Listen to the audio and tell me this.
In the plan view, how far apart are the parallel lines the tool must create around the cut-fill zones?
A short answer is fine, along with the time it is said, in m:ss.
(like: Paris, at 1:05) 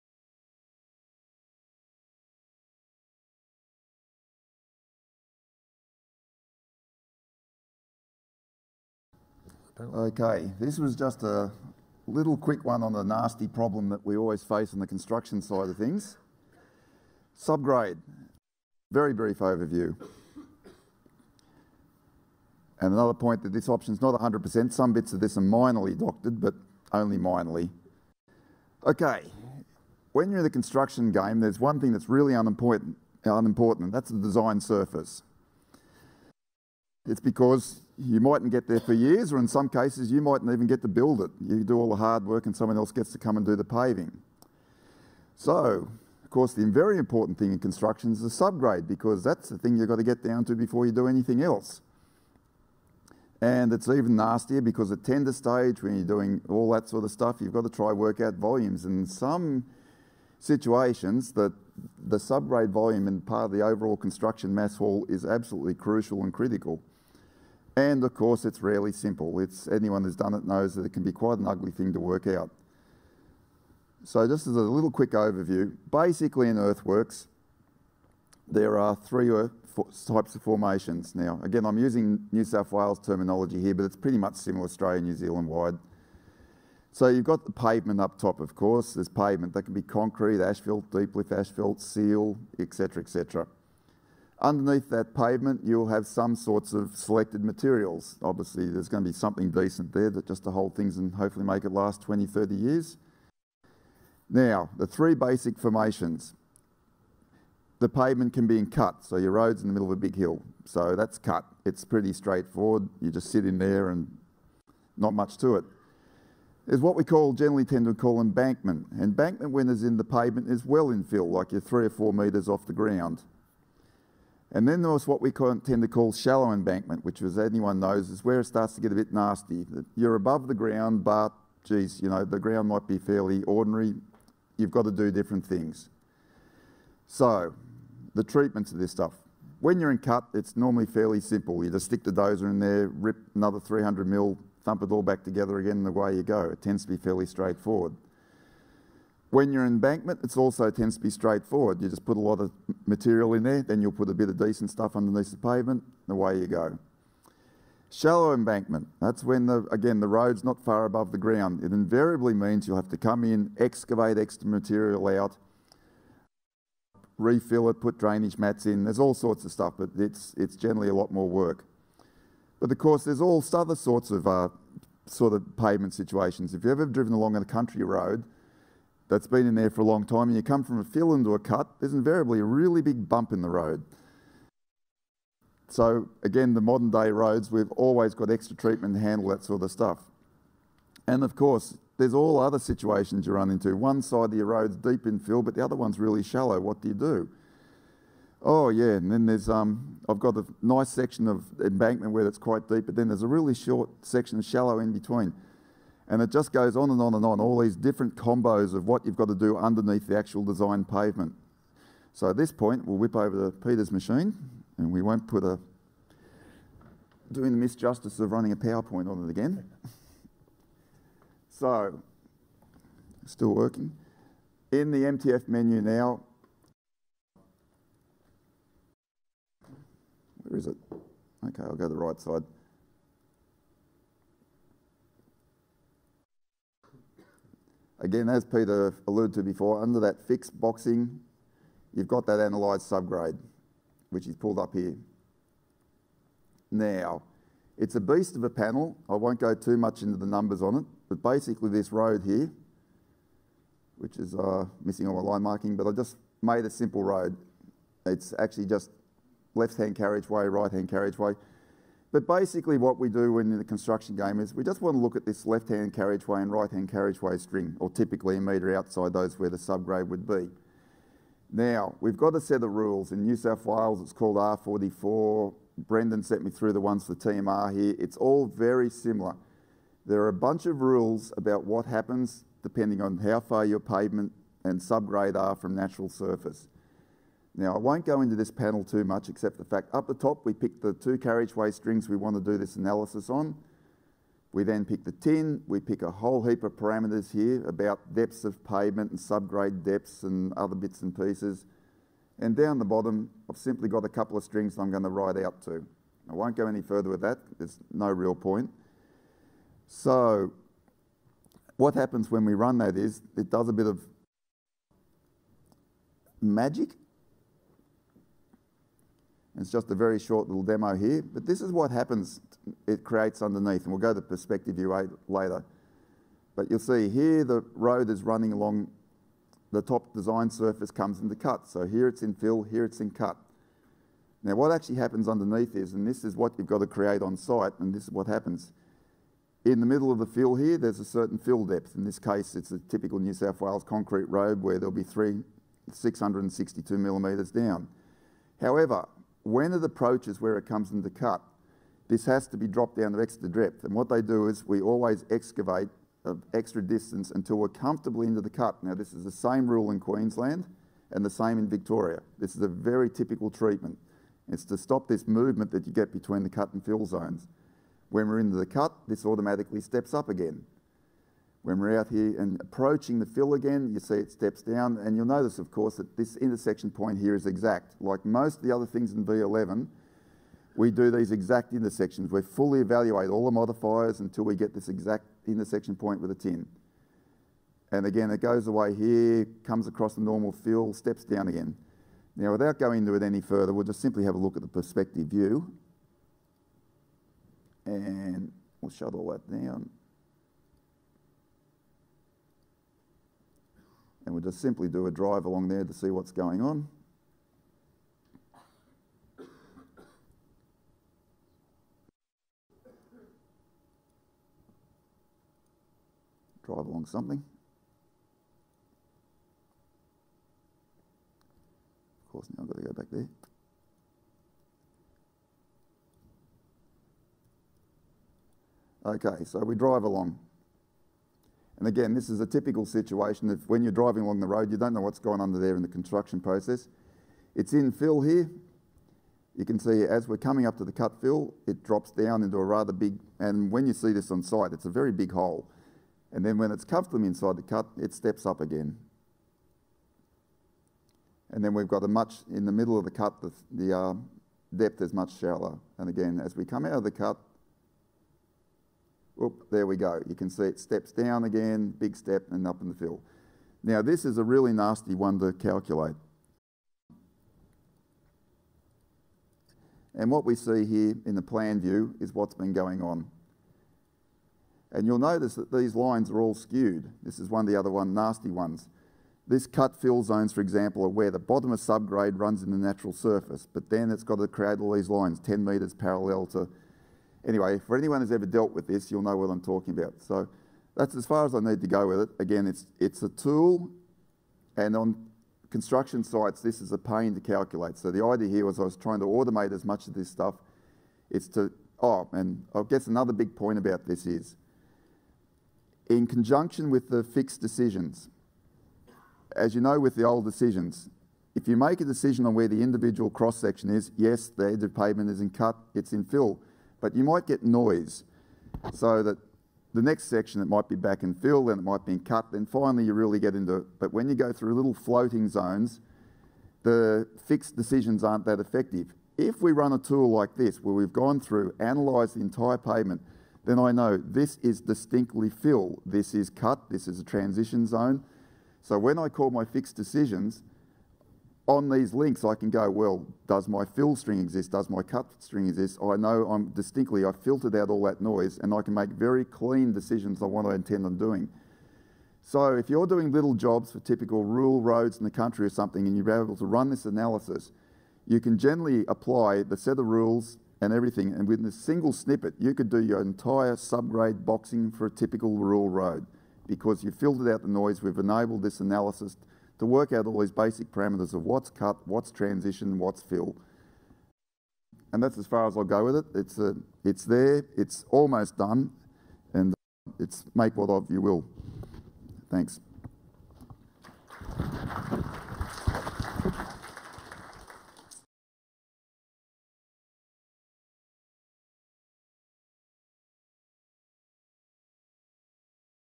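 10 metres, at 8:05.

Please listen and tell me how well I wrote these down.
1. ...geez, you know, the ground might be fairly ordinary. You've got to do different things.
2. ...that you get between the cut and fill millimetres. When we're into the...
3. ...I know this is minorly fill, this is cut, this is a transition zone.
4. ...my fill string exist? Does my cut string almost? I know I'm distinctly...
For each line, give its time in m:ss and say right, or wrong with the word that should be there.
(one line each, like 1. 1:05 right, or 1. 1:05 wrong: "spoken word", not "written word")
1. 2:11 right
2. 6:05 wrong: "zones", not "millimetres"
3. 8:53 wrong: "distinctly", not "minorly"
4. 9:03 wrong: "exist", not "almost".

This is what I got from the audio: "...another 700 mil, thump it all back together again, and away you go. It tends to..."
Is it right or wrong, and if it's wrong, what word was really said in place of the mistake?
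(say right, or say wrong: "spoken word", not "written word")
wrong: "300", not "700".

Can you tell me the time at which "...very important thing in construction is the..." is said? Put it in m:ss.
0:46.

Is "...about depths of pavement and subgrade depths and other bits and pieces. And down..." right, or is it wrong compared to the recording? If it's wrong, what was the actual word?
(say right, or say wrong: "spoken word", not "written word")
right.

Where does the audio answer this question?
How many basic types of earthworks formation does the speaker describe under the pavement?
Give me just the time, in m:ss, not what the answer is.
1:18.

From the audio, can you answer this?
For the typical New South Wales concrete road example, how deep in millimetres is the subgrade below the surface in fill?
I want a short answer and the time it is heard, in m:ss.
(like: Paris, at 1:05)
662 mm, at 5:45.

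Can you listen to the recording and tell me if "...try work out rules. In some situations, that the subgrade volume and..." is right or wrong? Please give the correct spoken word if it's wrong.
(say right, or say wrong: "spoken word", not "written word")
wrong: "volumes", not "rules".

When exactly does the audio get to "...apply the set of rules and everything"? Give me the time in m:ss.
9:19.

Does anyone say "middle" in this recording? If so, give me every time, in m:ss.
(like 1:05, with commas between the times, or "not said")
1:49, 5:39, 7:32.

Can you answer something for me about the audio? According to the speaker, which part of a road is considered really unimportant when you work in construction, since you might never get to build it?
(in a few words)
The design surface.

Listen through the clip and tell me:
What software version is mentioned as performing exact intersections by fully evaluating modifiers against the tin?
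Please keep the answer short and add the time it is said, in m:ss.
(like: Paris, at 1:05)
V11, at 6:19.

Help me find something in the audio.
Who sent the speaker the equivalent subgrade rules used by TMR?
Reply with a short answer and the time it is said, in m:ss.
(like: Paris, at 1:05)
Brendan, at 4:35.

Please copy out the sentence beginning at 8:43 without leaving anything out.
But when you go through little floating zones, the fixed decisions aren't that effective.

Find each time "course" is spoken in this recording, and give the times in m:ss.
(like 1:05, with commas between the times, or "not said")
0:46, 1:08, 1:28, 2:52, 3:11, 6:15, 7:02.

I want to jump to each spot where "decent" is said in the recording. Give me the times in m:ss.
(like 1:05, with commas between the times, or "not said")
1:39, 2:34.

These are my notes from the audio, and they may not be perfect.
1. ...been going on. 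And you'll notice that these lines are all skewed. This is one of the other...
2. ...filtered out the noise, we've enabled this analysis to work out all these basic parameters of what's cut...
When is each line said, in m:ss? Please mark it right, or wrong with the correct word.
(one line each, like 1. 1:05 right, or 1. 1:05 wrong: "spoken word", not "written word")
1. 7:52 right
2. 9:27 right.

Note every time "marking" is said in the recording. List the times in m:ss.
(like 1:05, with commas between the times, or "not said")
4:15.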